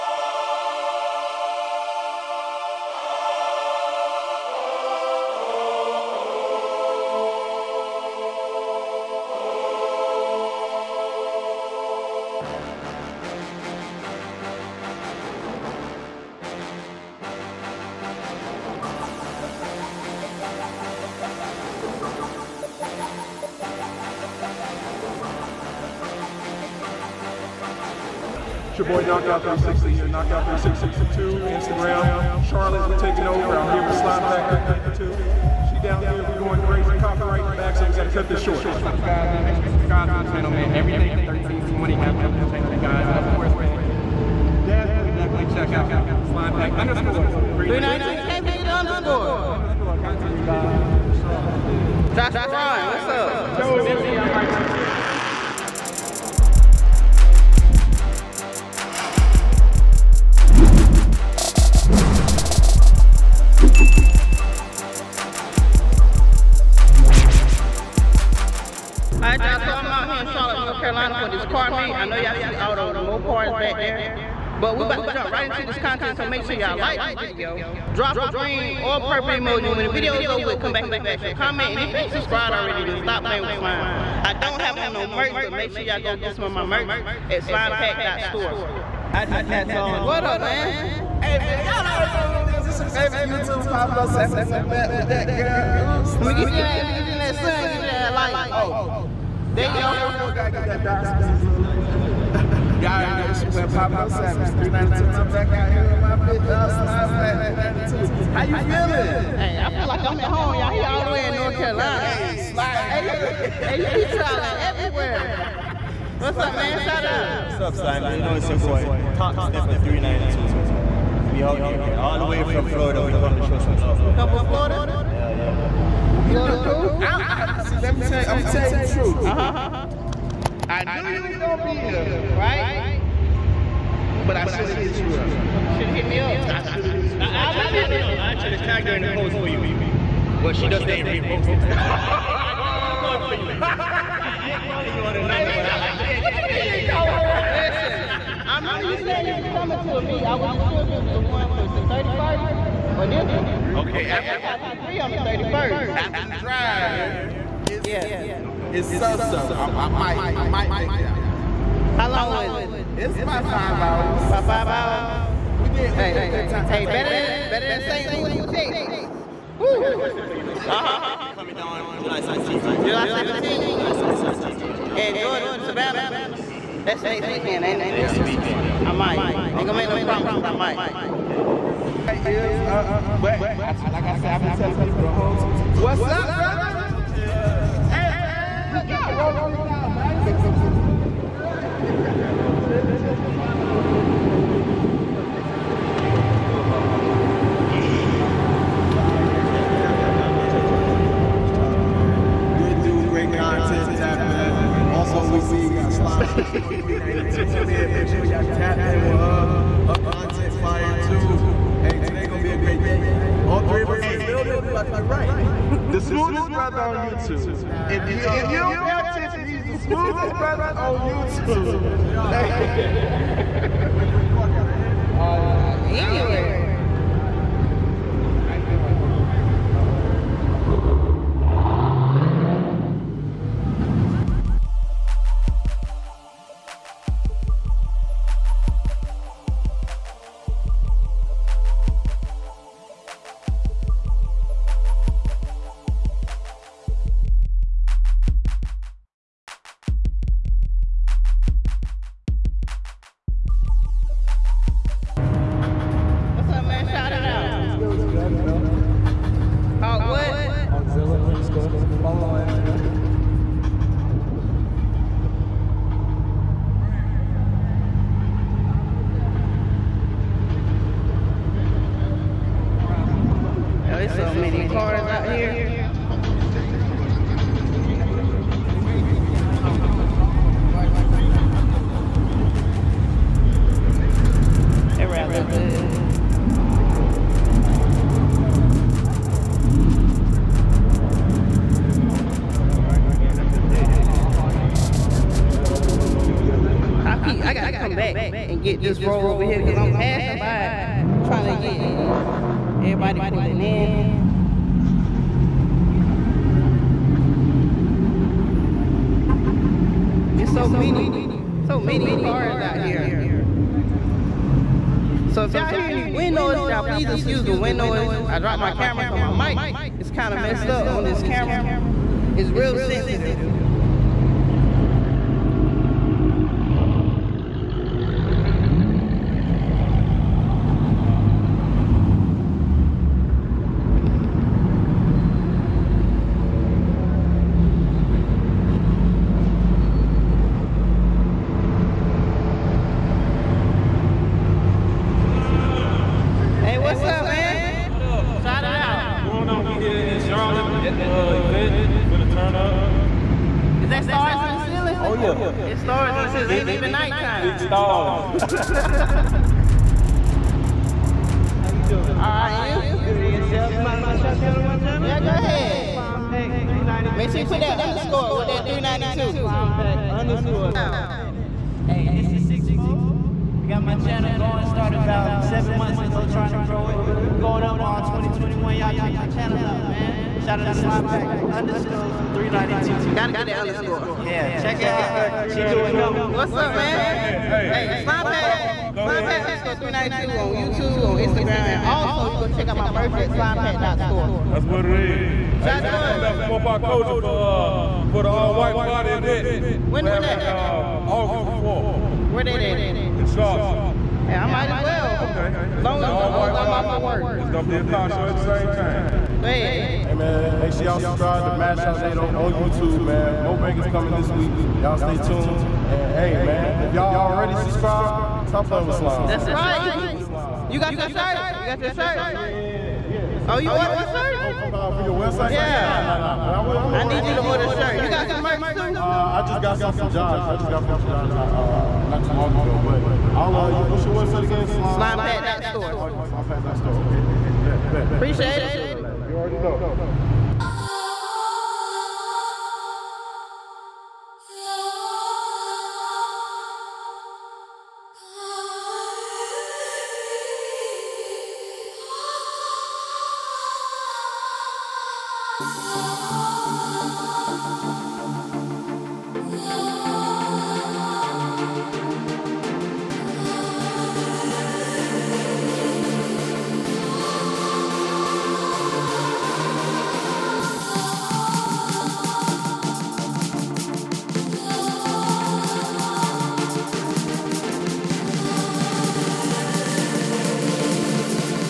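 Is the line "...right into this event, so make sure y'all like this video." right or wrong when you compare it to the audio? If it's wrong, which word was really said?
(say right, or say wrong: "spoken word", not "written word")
wrong: "content", not "event".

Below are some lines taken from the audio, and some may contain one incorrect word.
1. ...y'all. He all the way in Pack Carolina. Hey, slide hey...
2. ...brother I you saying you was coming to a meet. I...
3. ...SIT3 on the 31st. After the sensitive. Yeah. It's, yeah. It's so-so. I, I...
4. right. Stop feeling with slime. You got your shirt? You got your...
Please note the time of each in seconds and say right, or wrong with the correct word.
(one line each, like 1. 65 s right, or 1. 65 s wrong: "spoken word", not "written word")
1. 110 s wrong: "North", not "Pack"
2. 148 s wrong: "remember", not "brother"
3. 154 s wrong: "drive", not "sensitive"
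4. 419 s wrong: "playing", not "feeling".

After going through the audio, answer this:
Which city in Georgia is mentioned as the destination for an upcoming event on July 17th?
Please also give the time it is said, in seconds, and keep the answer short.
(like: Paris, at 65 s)
Savannah, at 175 s.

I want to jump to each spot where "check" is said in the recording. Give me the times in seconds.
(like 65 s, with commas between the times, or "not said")
45 s, 378 s, 384 s, 392 s.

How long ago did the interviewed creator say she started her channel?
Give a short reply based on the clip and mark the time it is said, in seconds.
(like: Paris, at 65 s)
7 months, at 375 s.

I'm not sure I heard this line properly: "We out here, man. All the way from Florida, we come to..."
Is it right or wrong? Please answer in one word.
right.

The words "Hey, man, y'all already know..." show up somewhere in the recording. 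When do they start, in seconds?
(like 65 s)
91 s.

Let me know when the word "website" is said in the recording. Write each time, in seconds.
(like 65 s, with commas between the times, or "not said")
425 s, 434 s.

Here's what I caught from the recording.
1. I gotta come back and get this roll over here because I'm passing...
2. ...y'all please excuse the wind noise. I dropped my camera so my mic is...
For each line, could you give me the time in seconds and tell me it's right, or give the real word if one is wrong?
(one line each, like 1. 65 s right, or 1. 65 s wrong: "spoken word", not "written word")
1. 297 s right
2. 316 s right.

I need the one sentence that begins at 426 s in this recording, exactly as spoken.
I'm I need you to order, order a shirt.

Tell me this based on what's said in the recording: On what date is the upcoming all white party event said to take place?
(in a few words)
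August 4th.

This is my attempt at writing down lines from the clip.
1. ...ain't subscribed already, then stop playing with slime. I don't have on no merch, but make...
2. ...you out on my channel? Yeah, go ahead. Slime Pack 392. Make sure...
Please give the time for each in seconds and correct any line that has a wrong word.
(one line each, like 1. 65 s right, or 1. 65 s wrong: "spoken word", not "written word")
1. 81 s right
2. 364 s right.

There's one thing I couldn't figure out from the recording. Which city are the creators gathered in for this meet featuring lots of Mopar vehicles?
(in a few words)
Charlotte, North Carolina.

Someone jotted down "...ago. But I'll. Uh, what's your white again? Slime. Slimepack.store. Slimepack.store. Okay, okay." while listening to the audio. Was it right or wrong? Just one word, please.
wrong.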